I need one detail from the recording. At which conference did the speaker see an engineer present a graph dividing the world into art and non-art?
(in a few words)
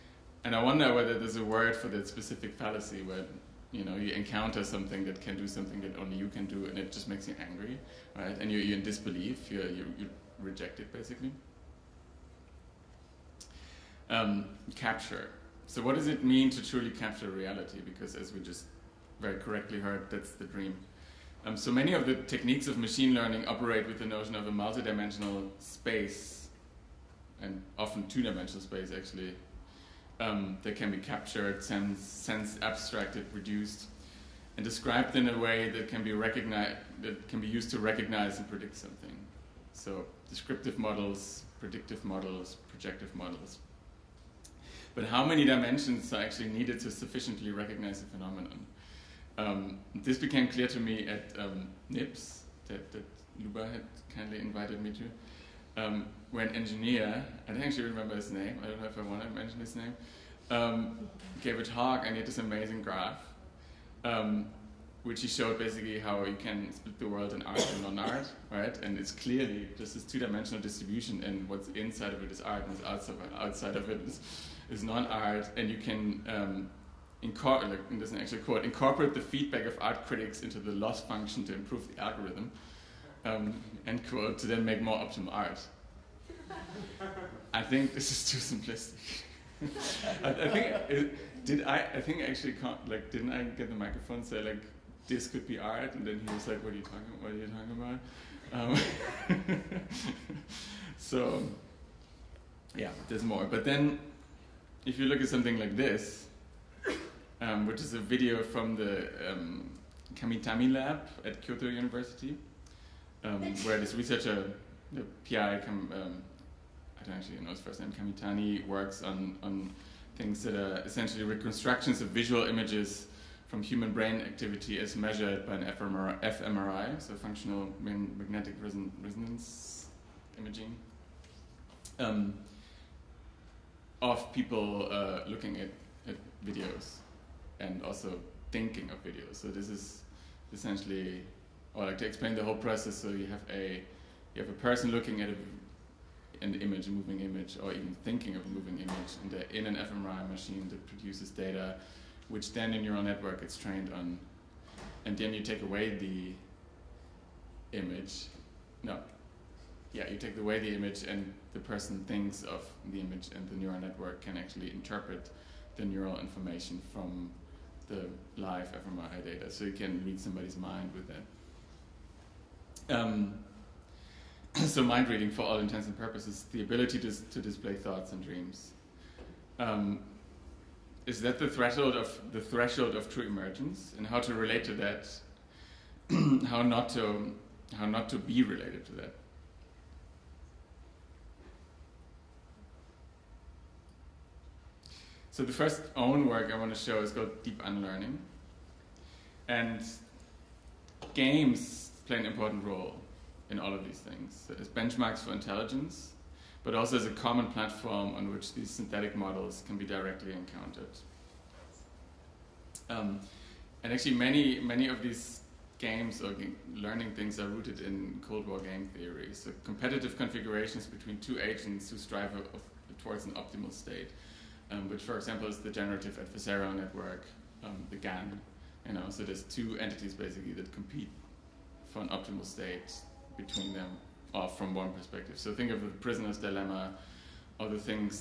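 NIPS.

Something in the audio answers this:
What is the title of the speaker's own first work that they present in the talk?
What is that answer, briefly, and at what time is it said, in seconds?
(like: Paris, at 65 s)
Deep Unlearning, at 197 s.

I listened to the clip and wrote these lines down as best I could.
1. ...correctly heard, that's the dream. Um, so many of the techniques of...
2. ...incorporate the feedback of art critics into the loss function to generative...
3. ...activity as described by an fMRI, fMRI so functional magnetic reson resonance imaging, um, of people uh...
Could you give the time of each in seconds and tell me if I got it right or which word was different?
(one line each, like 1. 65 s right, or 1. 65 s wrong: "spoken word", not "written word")
1. 19 s right
2. 78 s wrong: "improve", not "generative"
3. 124 s wrong: "measured", not "described".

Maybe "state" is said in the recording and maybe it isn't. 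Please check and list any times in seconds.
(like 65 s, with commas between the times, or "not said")
223 s, 232 s.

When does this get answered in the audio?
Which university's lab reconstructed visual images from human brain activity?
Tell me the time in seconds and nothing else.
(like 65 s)
111 s.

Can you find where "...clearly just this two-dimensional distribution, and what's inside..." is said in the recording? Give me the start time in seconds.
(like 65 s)
69 s.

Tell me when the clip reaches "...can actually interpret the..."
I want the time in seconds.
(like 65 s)
164 s.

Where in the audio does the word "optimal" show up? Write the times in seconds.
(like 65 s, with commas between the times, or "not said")
84 s, 223 s, 232 s.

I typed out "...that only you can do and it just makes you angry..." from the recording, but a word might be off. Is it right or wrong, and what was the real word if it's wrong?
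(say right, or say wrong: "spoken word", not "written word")
right.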